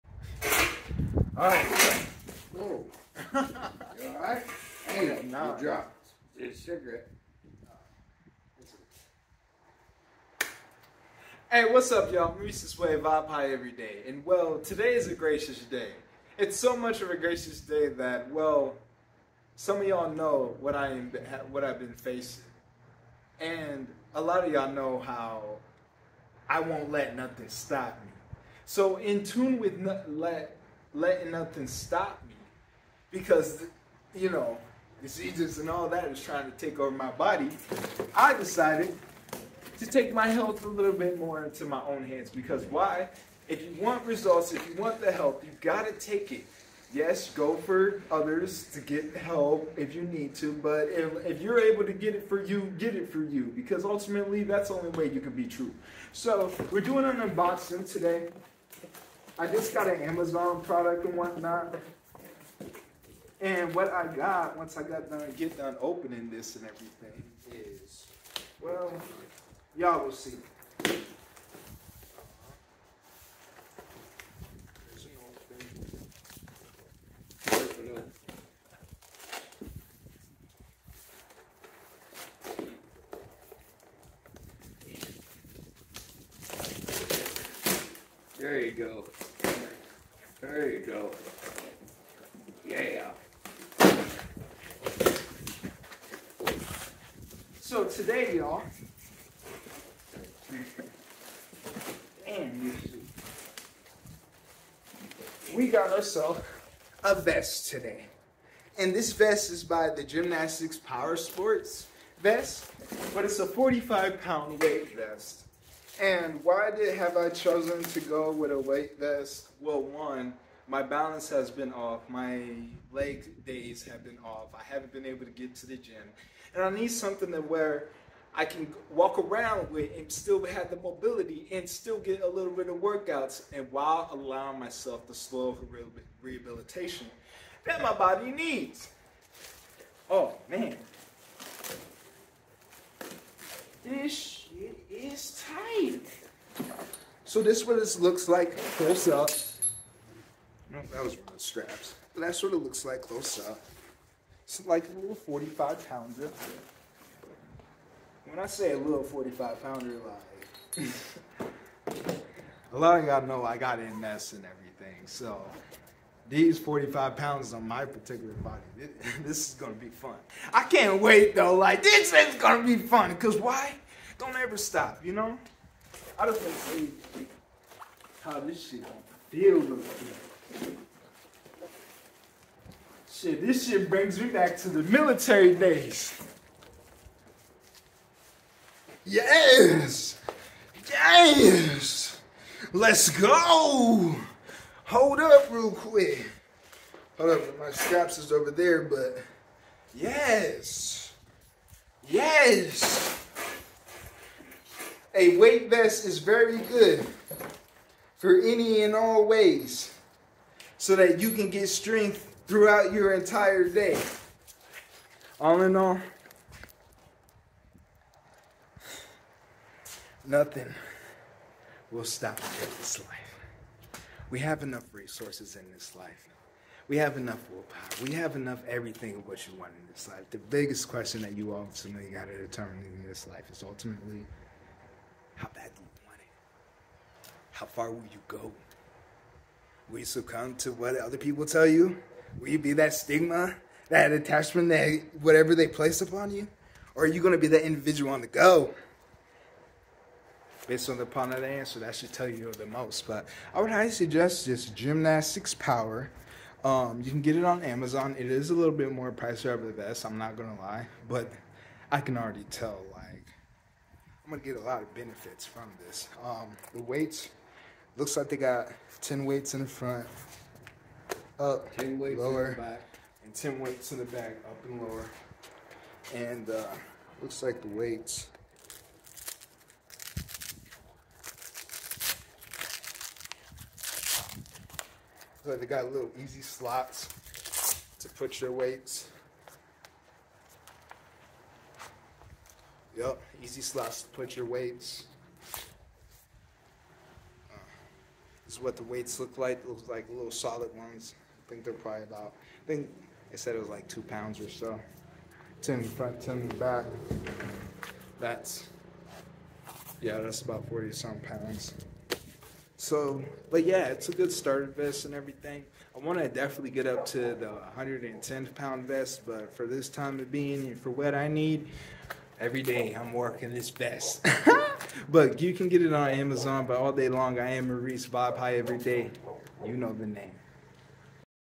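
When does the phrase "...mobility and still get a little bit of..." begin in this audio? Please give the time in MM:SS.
02:10.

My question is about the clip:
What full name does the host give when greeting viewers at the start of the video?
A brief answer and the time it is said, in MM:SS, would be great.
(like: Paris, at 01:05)
Maurice Wright, at 00:12.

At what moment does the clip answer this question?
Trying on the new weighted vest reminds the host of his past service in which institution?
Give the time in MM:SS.
03:04.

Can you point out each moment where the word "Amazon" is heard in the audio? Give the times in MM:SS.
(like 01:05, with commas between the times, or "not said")
01:00, 04:17, 05:26.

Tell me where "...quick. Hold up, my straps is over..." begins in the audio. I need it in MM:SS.
03:15.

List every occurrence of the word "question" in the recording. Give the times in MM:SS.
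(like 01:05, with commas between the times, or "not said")
03:50.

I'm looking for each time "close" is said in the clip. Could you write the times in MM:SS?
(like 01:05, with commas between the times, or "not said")
02:28, 02:33.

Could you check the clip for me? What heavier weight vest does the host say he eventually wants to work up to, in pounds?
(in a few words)
110 pounds.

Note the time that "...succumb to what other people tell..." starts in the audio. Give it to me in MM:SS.
04:00.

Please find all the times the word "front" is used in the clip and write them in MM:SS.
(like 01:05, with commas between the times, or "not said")
04:29, 05:05.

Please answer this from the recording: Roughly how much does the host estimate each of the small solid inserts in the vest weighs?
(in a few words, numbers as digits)
2 pounds.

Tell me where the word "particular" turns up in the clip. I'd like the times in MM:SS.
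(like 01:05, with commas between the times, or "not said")
02:47.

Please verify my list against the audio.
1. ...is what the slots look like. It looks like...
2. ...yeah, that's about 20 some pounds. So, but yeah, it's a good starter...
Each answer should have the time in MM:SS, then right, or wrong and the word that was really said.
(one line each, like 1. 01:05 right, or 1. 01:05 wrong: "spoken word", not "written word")
1. 04:58 wrong: "weights", not "slots"
2. 05:10 wrong: "40", not "20".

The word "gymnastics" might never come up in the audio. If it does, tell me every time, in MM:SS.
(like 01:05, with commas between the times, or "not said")
01:50, 04:14.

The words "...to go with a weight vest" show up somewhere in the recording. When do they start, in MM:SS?
01:57.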